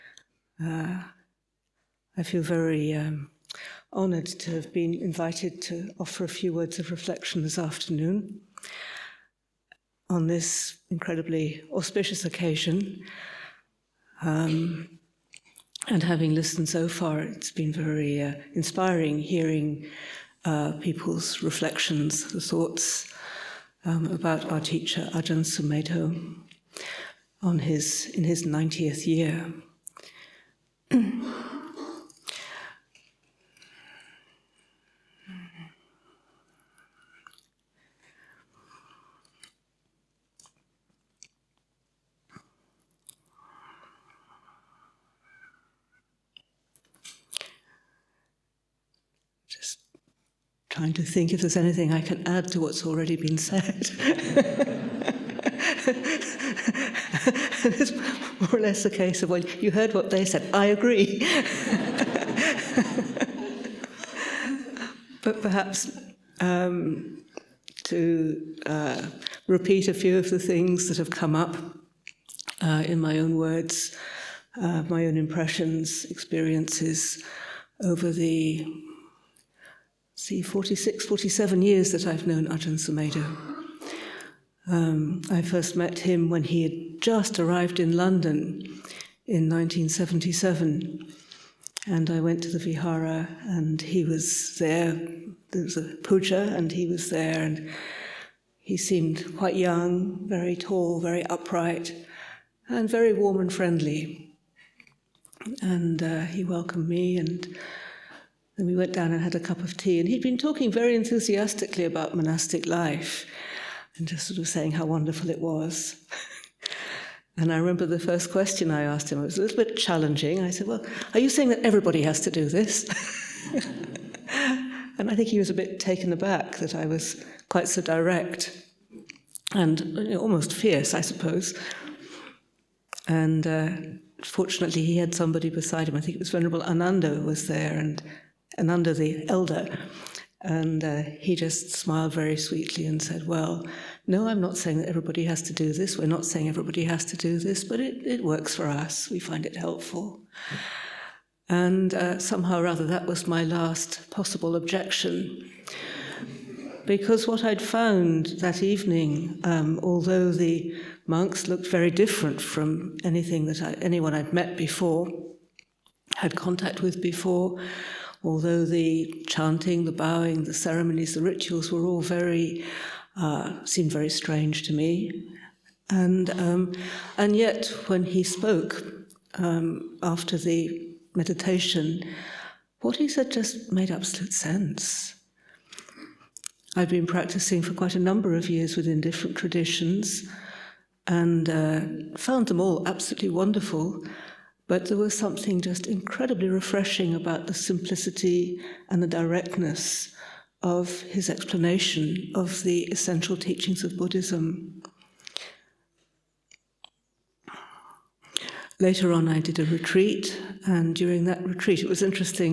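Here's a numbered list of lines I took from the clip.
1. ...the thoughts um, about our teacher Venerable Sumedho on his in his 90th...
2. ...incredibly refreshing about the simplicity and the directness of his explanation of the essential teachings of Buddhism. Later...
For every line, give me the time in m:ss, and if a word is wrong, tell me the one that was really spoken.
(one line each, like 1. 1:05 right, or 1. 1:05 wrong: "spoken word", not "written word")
1. 0:22 wrong: "Ajahn", not "Venerable"
2. 3:15 right.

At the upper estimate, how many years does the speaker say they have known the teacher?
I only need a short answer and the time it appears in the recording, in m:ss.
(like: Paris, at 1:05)
47, at 1:21.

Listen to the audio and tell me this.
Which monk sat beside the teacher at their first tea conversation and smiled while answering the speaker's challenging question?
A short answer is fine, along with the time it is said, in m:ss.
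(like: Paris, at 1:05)
Venerable Ananda, at 2:16.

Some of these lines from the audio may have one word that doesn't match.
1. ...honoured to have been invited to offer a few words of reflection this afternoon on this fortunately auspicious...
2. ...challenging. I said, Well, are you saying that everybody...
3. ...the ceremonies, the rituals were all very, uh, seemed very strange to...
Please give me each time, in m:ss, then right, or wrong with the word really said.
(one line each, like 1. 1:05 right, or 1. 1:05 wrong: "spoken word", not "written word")
1. 0:03 wrong: "incredibly", not "fortunately"
2. 1:59 right
3. 2:50 right.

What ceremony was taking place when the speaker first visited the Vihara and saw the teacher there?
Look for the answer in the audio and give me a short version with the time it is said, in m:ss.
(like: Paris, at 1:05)
puja, at 1:36.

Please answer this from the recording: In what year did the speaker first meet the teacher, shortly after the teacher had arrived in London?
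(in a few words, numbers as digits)
1977.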